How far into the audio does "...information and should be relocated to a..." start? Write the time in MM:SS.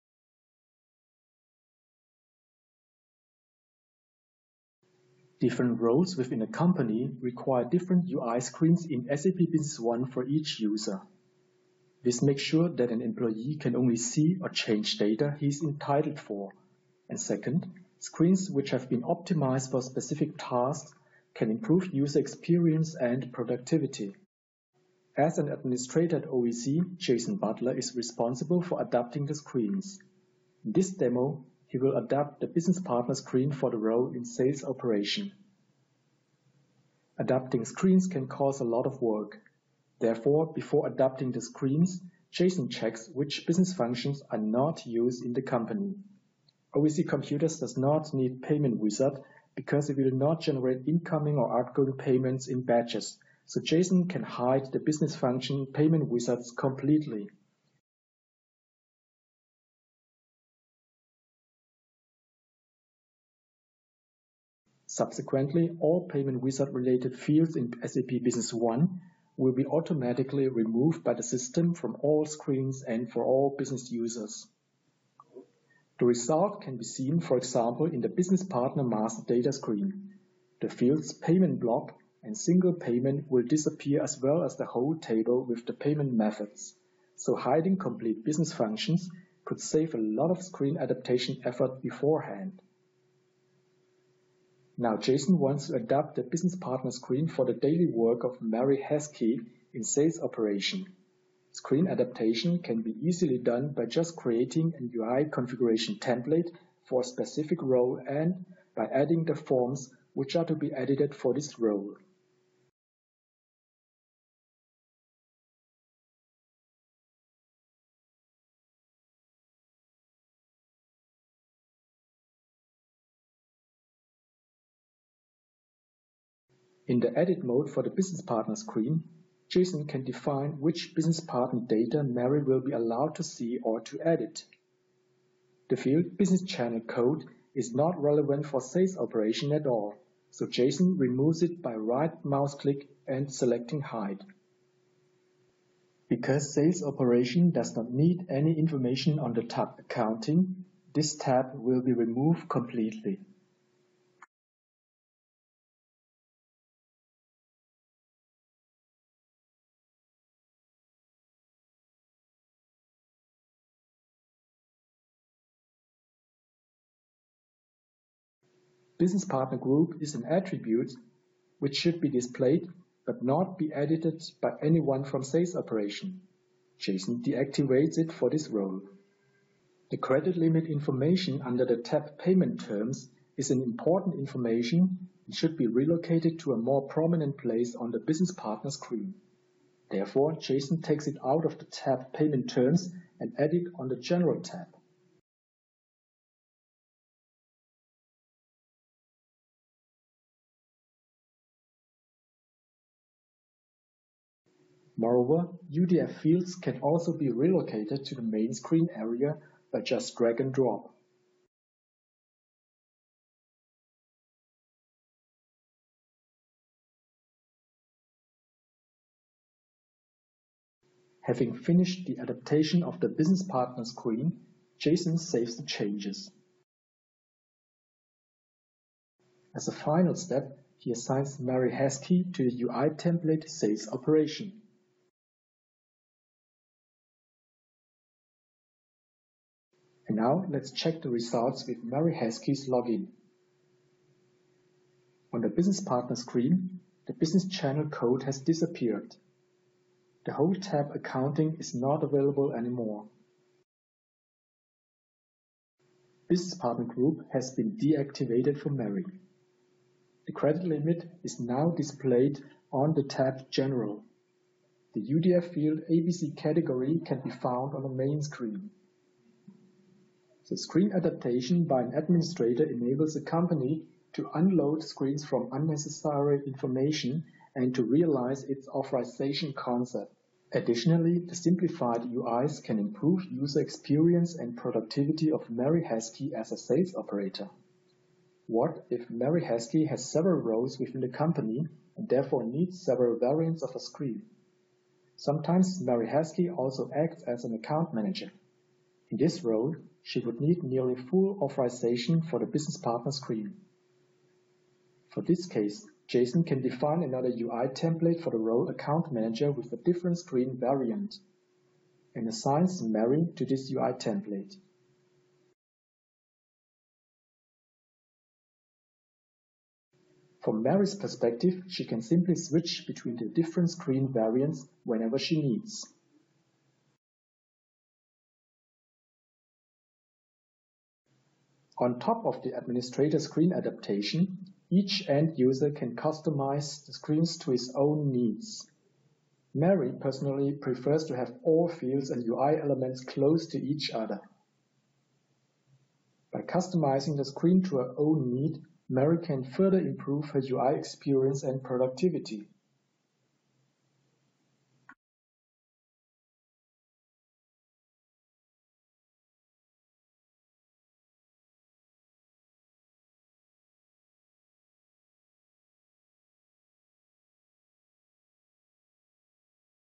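03:04.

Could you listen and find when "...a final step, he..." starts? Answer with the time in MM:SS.
03:49.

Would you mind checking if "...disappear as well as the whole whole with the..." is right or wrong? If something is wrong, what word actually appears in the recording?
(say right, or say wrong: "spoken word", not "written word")
wrong: "table", not "whole".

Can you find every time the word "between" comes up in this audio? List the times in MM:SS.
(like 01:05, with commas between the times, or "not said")
05:22.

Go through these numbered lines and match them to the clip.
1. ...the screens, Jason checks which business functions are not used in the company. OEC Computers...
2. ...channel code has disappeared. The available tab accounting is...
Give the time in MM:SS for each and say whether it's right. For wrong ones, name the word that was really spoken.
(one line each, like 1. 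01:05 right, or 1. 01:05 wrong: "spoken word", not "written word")
1. 00:41 right
2. 04:07 wrong: "whole", not "available".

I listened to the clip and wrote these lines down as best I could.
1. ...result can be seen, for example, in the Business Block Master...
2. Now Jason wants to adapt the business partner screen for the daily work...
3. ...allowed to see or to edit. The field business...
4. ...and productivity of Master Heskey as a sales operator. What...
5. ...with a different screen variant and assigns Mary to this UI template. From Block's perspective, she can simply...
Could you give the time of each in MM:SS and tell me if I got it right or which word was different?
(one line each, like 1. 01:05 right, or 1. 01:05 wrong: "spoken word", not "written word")
1. 01:16 wrong: "Partner", not "Block"
2. 01:34 right
3. 02:12 right
4. 04:44 wrong: "Mary", not "Master"
5. 05:09 wrong: "Mary", not "Block".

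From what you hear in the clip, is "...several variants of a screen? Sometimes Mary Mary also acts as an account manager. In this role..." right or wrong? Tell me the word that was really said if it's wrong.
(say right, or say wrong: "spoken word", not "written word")
wrong: "Heskey", not "Mary".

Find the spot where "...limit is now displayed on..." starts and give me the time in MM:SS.
04:20.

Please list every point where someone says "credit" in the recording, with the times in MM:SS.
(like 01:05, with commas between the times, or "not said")
02:59, 04:20.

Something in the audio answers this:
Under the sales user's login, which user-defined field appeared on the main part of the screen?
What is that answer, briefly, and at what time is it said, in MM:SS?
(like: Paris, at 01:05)
ABC category, at 04:25.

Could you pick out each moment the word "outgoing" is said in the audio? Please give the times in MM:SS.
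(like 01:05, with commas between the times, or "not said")
00:51.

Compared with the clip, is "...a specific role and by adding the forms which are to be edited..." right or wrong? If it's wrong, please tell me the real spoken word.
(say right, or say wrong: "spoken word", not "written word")
right.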